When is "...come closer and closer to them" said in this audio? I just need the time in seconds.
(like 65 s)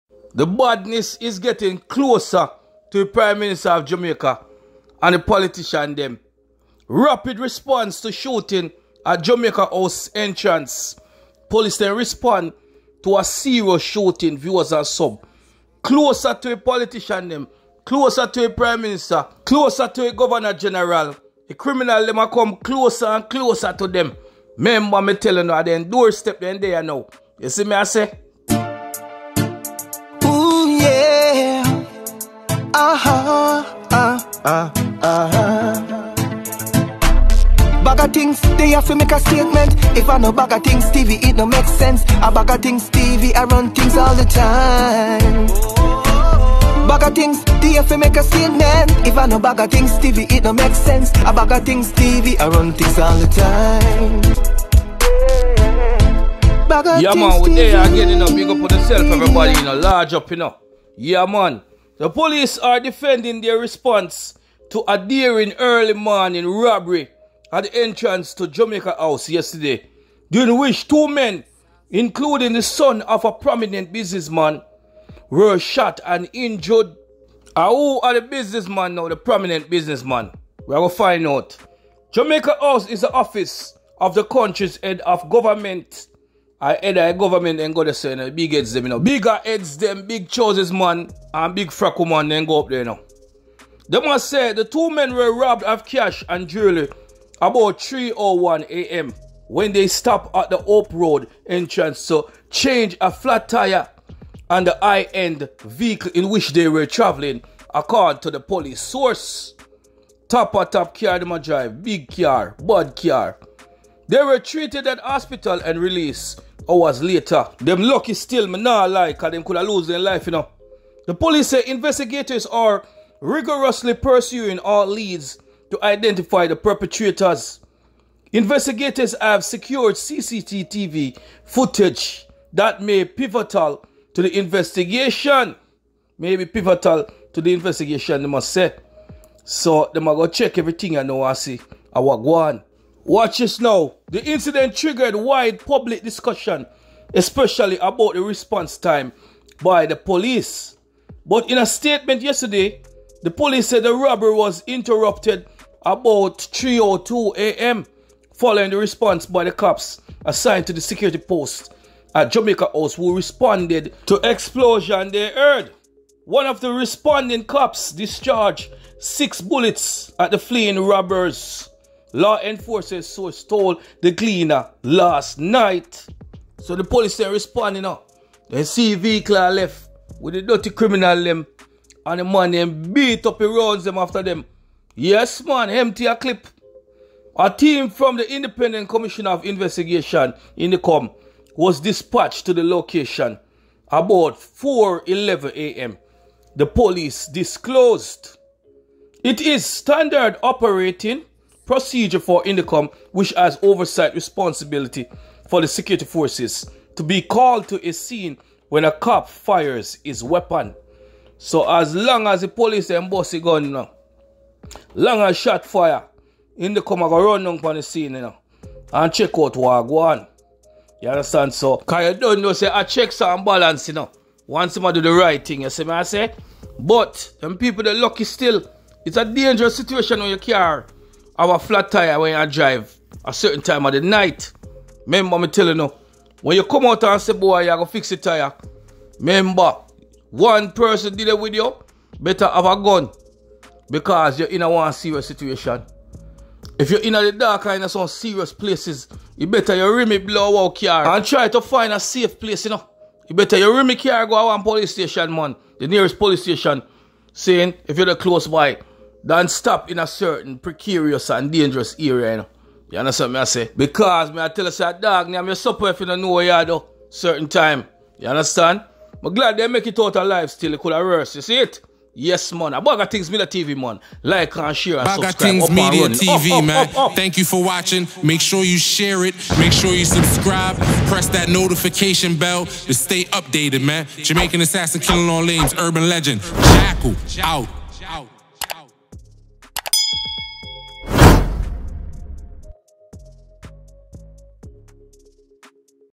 22 s.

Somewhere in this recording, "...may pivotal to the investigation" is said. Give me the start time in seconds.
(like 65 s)
132 s.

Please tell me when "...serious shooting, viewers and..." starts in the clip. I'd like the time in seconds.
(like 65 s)
13 s.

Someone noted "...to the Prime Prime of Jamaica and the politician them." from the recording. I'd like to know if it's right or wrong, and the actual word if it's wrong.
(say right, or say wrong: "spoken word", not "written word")
wrong: "Minister", not "Prime".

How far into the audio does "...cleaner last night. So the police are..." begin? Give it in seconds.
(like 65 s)
174 s.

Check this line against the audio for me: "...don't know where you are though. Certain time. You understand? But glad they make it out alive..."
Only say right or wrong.
right.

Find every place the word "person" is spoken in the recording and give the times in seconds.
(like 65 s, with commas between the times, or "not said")
240 s.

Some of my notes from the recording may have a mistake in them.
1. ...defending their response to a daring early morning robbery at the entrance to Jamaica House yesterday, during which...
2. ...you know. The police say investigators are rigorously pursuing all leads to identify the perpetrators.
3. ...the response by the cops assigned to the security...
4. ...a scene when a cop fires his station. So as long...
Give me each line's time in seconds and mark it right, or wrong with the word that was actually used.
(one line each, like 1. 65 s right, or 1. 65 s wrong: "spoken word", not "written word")
1. 62 s right
2. 120 s right
3. 158 s right
4. 207 s wrong: "weapon", not "station".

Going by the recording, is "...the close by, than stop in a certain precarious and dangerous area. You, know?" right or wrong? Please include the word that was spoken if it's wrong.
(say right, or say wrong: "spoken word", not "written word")
right.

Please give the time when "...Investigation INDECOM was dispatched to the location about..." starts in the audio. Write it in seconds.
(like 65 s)
189 s.